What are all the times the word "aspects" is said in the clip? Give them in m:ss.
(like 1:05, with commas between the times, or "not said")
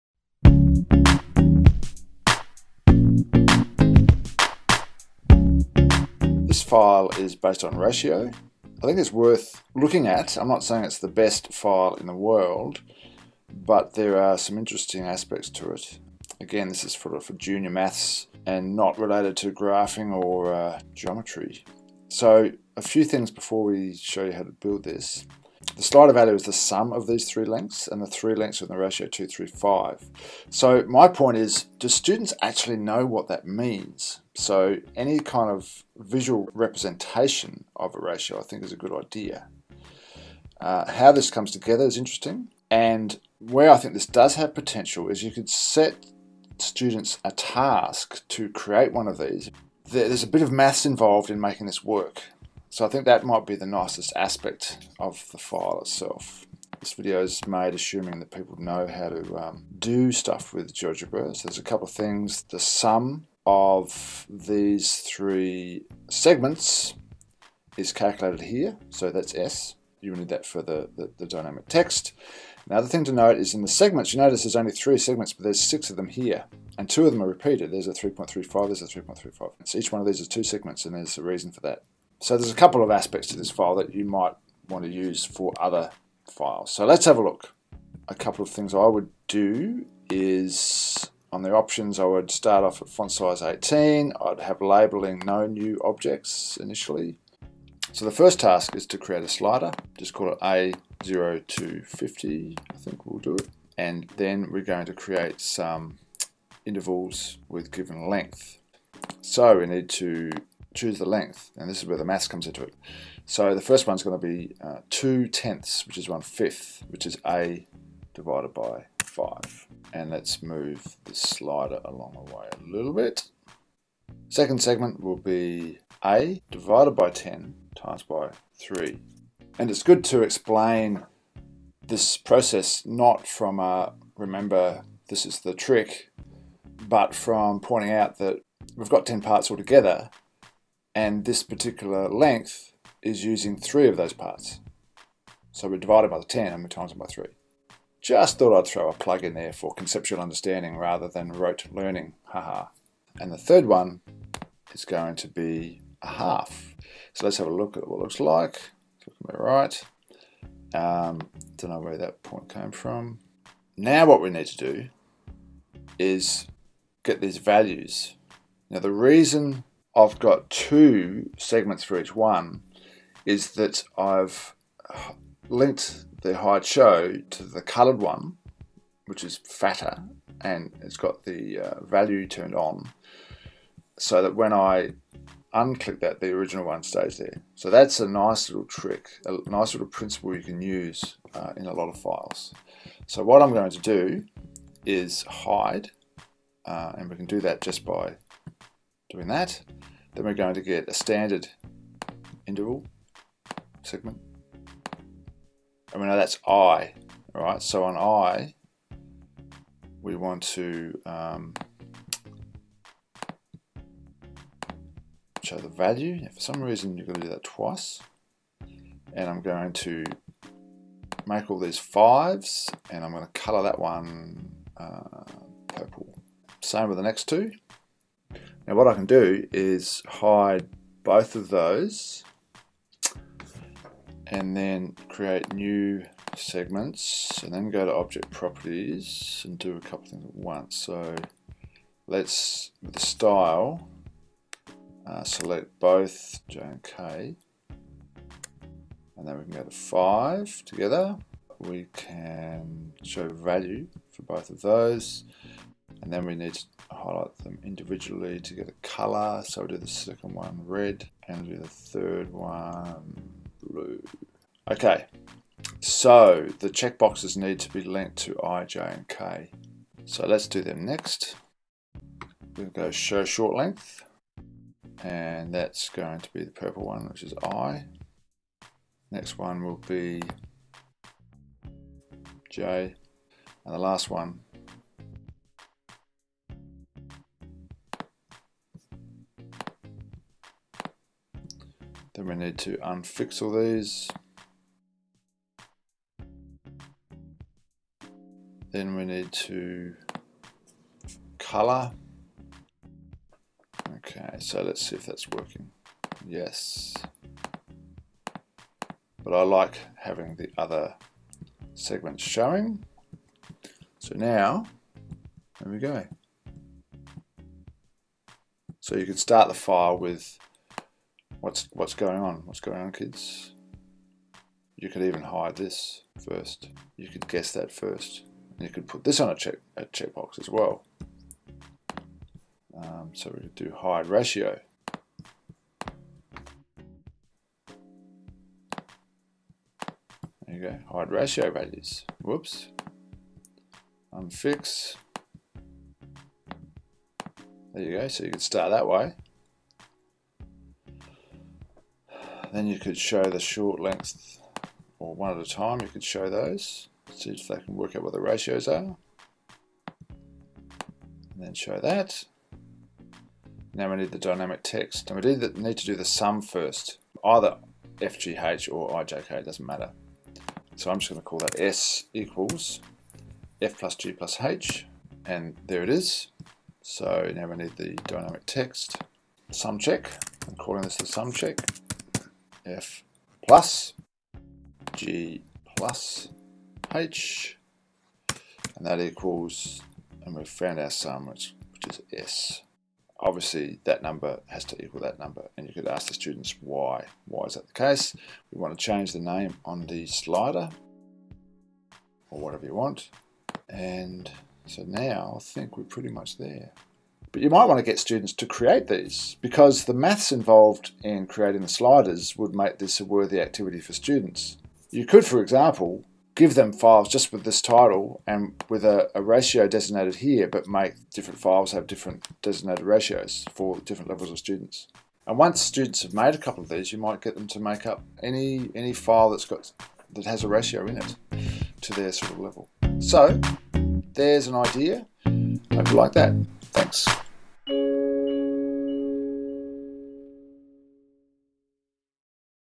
0:15, 0:54, 1:22.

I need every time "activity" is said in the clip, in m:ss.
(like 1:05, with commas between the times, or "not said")
6:53.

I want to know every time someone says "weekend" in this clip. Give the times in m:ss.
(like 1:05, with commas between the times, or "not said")
not said.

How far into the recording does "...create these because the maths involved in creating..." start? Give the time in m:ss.
6:48.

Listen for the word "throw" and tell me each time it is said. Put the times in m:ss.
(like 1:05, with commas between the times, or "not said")
2:28.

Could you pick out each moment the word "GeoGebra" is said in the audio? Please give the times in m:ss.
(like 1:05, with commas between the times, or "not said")
1:00.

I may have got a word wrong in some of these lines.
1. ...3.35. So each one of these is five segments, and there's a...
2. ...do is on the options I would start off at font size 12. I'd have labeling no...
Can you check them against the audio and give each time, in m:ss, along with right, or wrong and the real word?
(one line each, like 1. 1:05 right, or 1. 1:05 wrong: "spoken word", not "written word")
1. 1:18 wrong: "two", not "five"
2. 1:29 wrong: "18", not "12".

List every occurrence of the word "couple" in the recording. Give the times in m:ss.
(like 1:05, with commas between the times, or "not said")
1:01, 1:22, 1:28, 3:59, 7:06.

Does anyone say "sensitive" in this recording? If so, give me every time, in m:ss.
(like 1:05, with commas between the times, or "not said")
not said.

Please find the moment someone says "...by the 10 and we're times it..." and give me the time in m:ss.
2:26.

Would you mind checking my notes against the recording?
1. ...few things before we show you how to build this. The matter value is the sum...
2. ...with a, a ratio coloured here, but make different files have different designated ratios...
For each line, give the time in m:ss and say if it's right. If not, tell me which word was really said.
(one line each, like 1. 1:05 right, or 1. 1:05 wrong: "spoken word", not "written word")
1. 0:22 wrong: "slider", not "matter"
2. 6:58 wrong: "designated", not "coloured".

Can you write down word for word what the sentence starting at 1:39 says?
Just call it A0250, I think we'll do it.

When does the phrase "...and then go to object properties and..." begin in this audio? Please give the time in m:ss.
3:57.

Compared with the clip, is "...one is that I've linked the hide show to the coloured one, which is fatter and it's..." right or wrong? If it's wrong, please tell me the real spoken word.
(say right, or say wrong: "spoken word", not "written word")
right.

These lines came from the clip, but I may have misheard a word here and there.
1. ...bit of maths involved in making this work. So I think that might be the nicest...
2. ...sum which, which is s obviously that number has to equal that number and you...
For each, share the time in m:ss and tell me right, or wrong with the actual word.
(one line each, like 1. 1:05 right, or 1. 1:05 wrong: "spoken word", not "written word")
1. 0:50 right
2. 6:30 right.